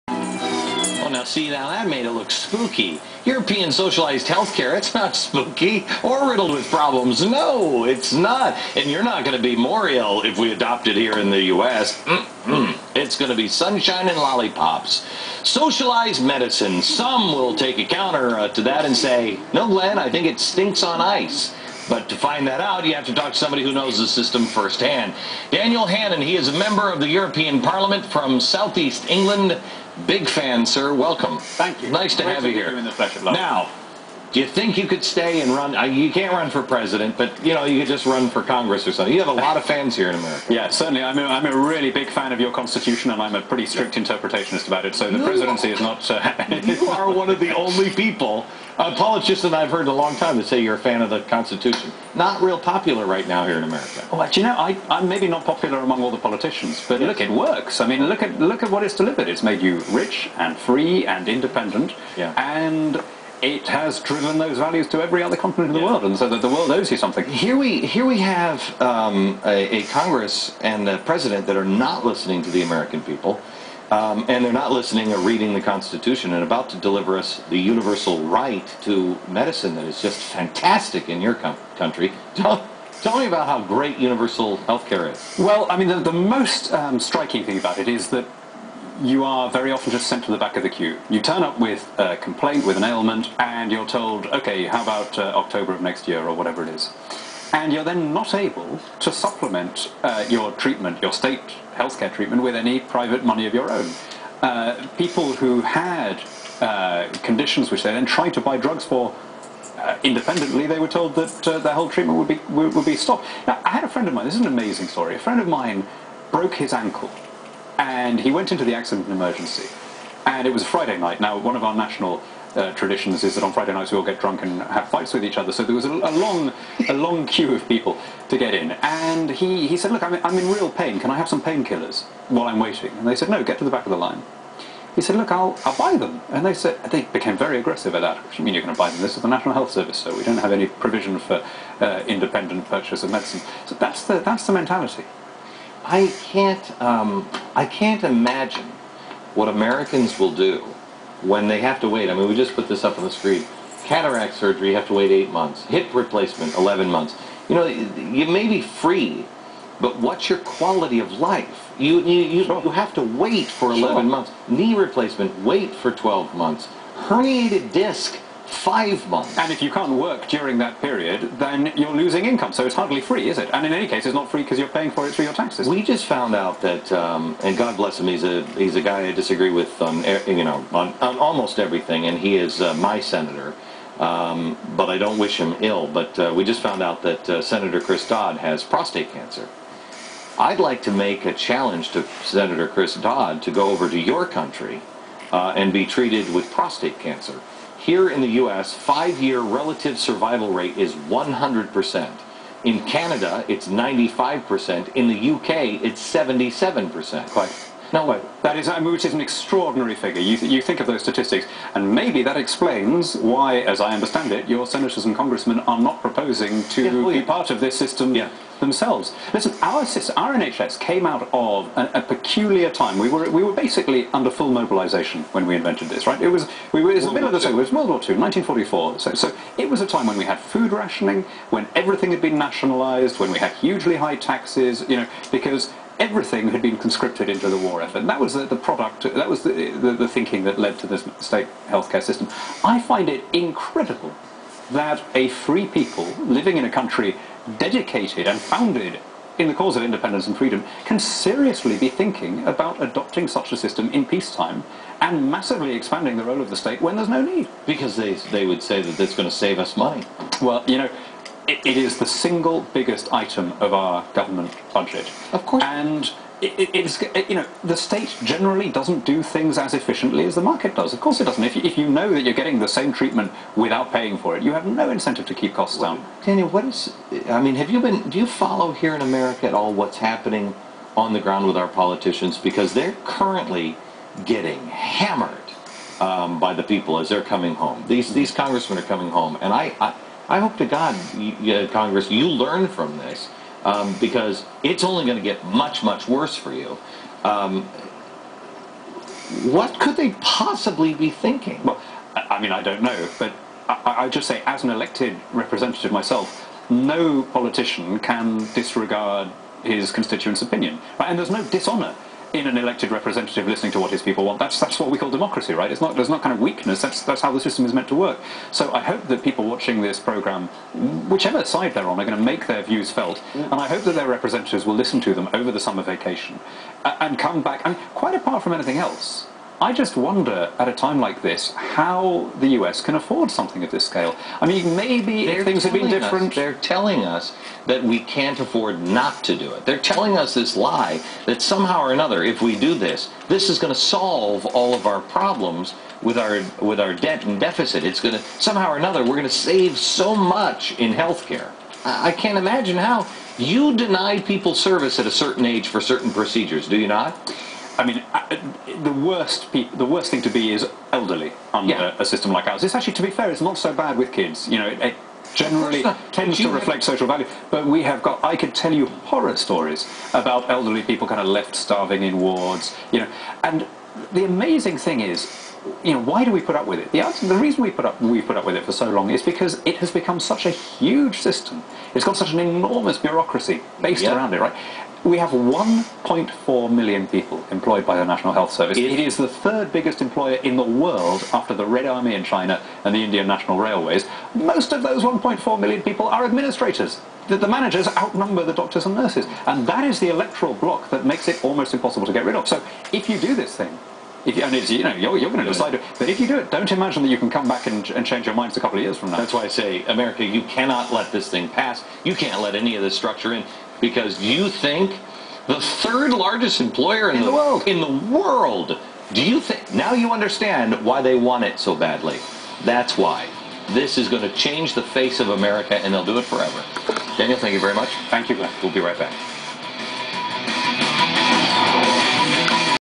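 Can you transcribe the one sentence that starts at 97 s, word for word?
and you're then not able to supplement uh, your treatment, your state healthcare treatment, with any private money of your own.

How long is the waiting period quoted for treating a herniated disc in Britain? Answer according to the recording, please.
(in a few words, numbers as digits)
5 months.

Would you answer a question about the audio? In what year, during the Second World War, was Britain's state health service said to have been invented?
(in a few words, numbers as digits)
1944.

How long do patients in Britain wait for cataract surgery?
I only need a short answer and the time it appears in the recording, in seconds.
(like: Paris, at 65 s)
8 months, at 155 s.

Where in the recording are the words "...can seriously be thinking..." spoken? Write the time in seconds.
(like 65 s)
250 s.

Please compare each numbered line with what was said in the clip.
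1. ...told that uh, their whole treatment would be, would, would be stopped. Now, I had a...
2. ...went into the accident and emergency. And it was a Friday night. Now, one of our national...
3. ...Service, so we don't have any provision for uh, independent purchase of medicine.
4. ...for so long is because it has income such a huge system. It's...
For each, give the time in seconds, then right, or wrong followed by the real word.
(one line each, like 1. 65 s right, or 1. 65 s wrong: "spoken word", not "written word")
1. 110 s right
2. 118 s right
3. 139 s right
4. 378 s wrong: "become", not "income".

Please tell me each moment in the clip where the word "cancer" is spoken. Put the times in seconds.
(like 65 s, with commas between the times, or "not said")
189 s, 196 s.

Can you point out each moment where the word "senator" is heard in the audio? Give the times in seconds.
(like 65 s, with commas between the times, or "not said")
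182 s, 187 s, 192 s, 214 s.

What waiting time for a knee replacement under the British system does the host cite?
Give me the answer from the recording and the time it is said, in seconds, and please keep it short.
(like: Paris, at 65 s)
12 months, at 165 s.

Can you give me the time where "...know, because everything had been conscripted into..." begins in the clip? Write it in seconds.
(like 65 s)
234 s.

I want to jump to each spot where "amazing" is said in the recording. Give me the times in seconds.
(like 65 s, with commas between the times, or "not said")
114 s, 374 s.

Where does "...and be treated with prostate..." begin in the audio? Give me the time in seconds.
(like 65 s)
195 s.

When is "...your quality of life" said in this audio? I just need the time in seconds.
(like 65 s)
160 s.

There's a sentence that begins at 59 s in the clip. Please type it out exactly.
It's made you rich and free and independent, yeah.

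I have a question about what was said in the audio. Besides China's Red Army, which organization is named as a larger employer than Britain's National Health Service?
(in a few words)
Indian National Railways.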